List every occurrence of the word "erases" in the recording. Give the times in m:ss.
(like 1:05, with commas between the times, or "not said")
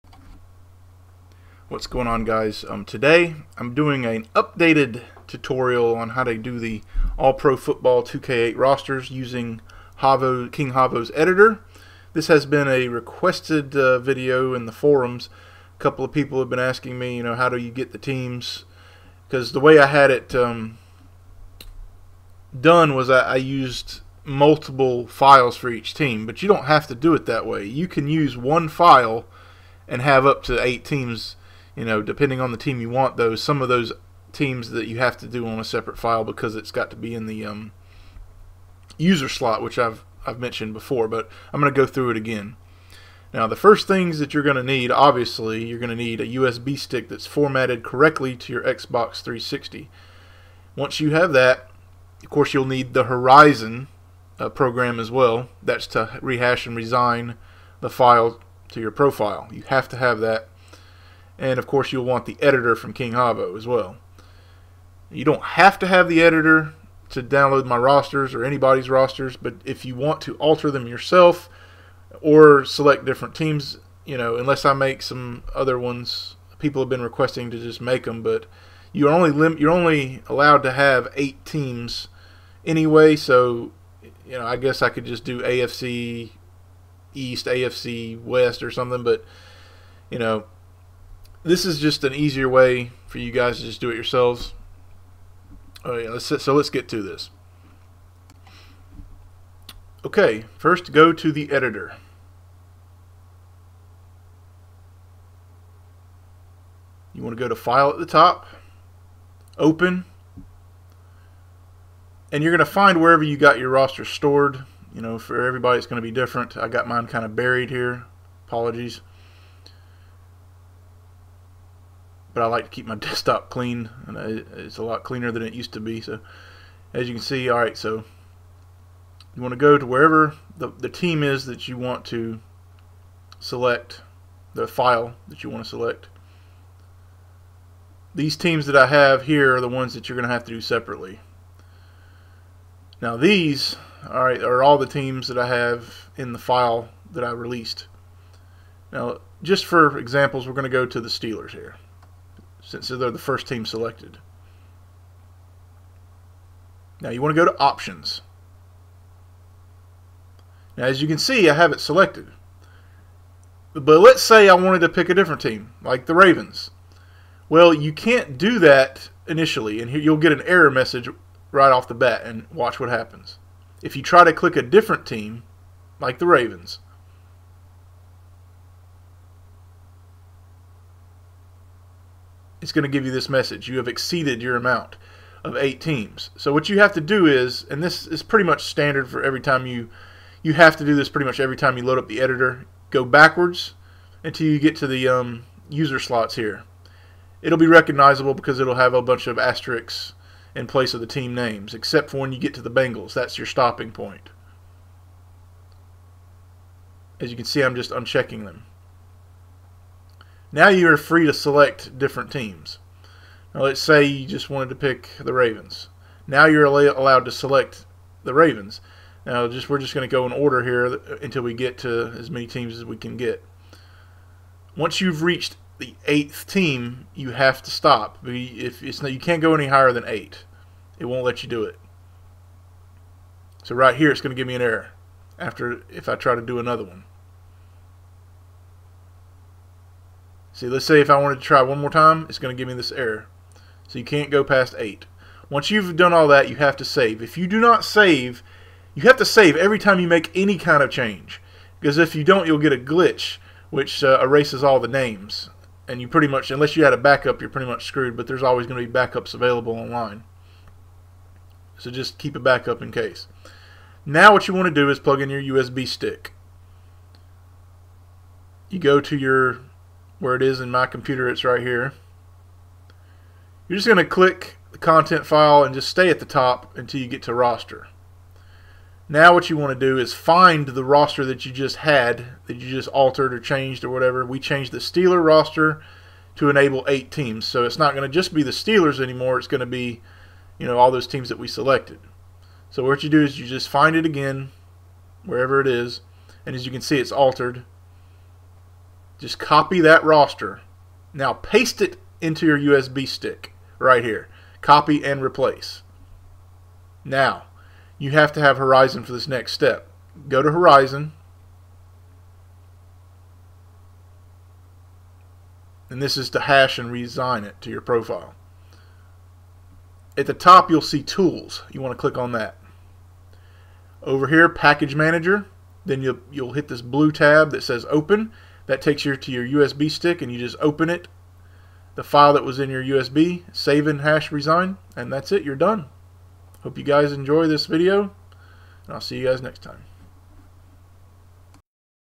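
4:14.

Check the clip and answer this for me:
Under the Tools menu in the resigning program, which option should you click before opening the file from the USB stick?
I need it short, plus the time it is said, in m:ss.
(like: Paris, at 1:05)
Package Manager, at 5:24.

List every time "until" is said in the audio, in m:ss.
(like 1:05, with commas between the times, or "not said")
3:14, 3:41, 4:36.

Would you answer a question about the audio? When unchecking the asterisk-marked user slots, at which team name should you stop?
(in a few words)
Bengals.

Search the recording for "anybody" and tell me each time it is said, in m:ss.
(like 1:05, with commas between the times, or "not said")
1:08.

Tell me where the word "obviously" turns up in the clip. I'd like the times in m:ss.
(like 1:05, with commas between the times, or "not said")
0:44.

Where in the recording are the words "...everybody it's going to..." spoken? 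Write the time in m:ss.
1:55.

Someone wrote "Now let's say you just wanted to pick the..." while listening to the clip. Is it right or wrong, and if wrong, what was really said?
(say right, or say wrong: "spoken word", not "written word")
right.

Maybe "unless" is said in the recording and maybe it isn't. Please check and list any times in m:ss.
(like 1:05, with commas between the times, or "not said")
1:14, 4:16.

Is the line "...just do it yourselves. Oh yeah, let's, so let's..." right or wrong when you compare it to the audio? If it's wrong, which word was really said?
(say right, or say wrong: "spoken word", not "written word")
right.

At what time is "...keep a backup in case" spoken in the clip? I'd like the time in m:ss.
4:22.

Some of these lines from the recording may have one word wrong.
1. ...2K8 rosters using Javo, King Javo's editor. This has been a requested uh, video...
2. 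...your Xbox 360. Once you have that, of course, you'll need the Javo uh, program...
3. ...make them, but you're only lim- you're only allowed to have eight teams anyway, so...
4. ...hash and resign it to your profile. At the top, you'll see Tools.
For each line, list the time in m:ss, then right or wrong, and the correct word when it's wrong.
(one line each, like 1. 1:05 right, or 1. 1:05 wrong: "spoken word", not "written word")
1. 0:08 right
2. 0:48 wrong: "Horizon", not "Javo"
3. 1:17 right
4. 5:16 right.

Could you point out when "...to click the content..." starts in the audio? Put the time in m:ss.
4:33.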